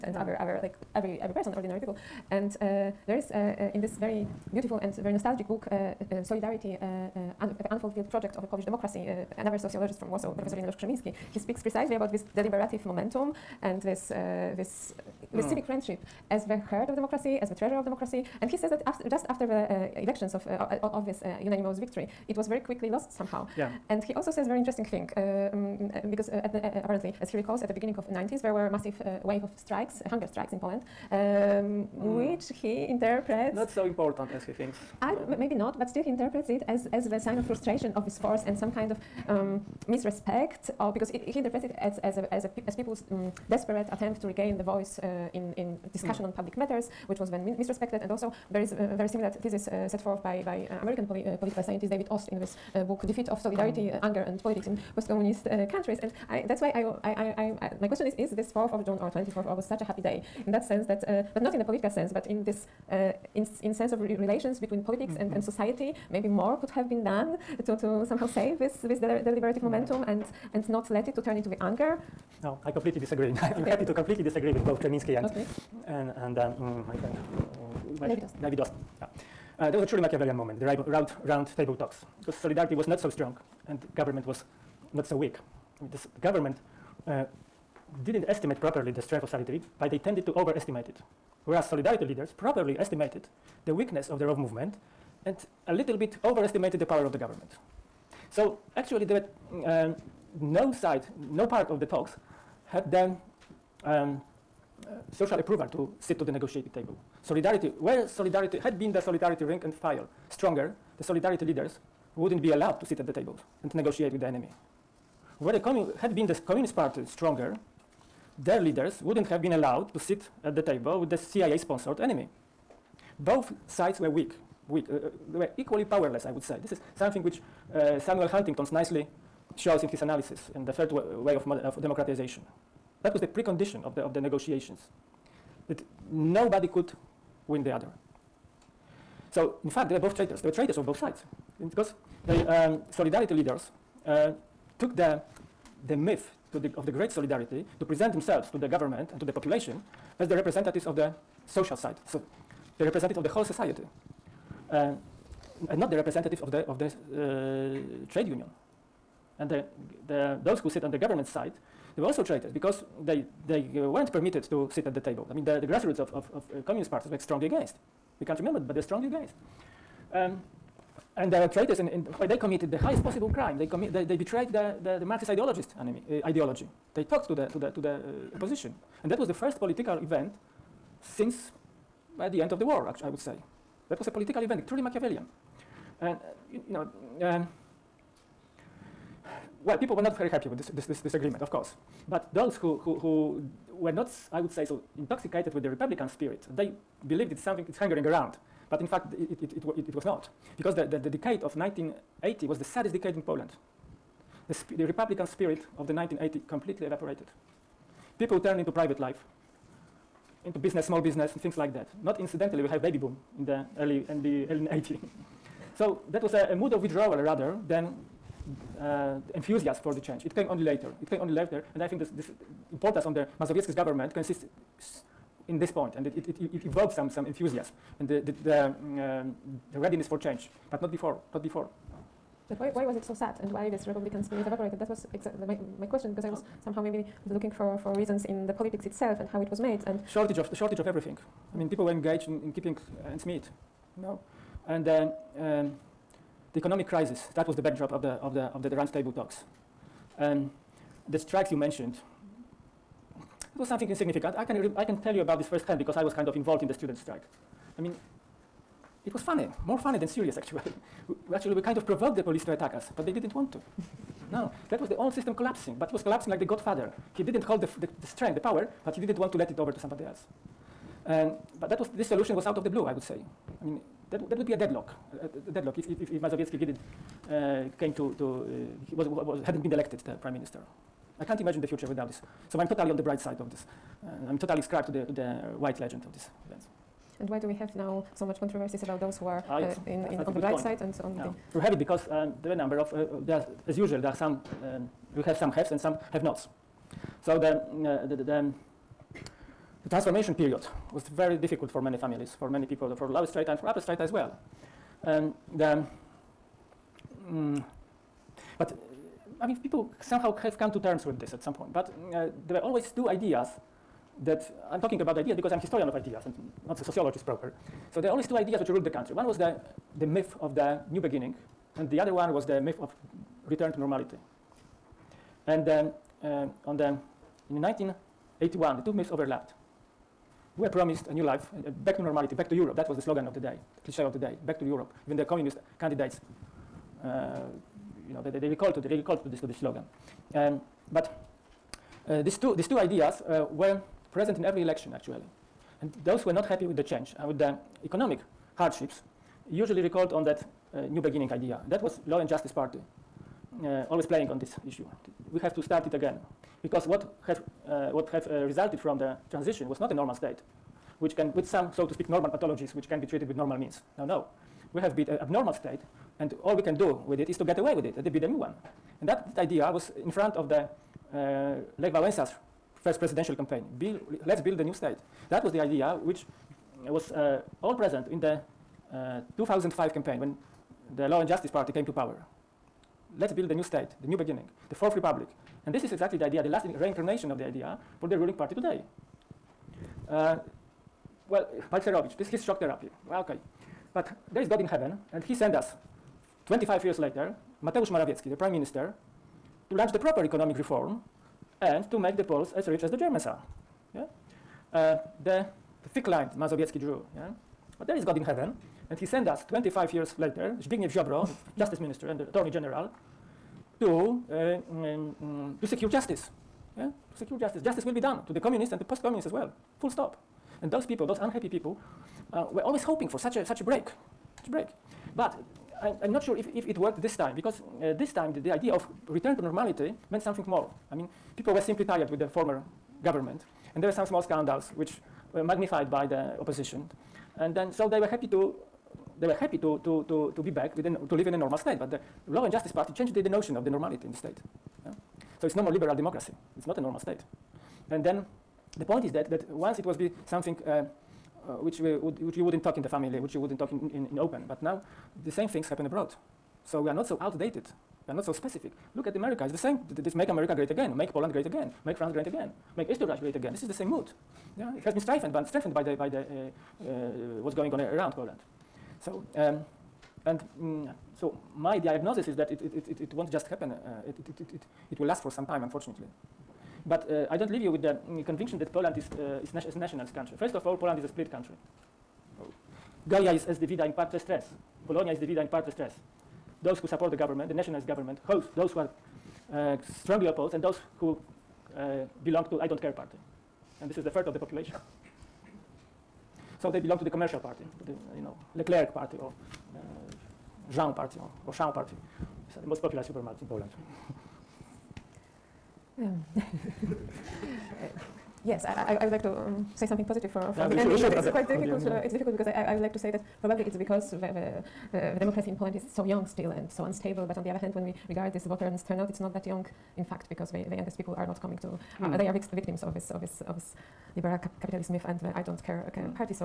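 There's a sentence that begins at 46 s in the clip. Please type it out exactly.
on public matters, which was then misrespected.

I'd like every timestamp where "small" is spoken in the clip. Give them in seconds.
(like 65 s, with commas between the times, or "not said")
210 s, 434 s.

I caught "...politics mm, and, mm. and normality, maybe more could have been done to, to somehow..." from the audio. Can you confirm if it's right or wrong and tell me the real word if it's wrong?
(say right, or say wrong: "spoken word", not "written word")
wrong: "society", not "normality".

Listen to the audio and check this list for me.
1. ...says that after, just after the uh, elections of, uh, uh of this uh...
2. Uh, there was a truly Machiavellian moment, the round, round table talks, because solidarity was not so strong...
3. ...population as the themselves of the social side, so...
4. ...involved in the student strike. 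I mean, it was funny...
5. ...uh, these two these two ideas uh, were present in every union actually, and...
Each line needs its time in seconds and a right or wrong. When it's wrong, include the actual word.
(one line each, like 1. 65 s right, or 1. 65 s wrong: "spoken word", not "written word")
1. 18 s right
2. 79 s right
3. 149 s wrong: "representatives", not "themselves"
4. 256 s right
5. 342 s wrong: "election", not "union".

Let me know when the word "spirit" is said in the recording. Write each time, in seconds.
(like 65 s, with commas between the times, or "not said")
196 s, 205 s, 234 s.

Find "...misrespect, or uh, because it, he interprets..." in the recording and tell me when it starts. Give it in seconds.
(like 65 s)
39 s.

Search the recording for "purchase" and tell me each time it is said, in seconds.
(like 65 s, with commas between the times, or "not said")
not said.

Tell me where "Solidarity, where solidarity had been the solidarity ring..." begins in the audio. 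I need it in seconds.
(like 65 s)
107 s.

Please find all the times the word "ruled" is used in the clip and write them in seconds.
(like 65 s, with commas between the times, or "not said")
318 s.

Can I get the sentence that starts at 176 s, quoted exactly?
They talked to the, to the, to the uh, opposition.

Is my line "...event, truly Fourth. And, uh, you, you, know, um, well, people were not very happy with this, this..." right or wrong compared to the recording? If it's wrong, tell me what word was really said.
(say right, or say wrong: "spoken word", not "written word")
wrong: "Machiavellian", not "Fourth".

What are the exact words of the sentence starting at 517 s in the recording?
But on the other hand, when we regard this voters' turnout, it's not that young.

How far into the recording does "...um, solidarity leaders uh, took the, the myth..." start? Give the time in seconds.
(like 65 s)
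142 s.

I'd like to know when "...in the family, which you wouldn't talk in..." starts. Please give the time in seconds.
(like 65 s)
452 s.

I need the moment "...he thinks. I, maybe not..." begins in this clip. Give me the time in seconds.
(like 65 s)
34 s.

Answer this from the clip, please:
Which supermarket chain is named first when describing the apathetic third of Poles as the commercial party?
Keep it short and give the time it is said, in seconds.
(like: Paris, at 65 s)
Leclerc, at 498 s.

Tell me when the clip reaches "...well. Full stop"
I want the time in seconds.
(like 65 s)
419 s.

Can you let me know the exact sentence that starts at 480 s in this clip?
First of all, Poland is a split country.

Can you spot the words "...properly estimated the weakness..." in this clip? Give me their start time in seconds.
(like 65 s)
92 s.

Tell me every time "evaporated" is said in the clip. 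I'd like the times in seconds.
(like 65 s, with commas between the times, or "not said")
206 s, 234 s.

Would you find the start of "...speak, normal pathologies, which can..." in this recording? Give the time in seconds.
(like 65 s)
361 s.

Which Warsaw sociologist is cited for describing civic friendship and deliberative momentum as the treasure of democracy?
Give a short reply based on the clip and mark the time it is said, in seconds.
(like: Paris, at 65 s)
Ireneusz Krzemiński, at 10 s.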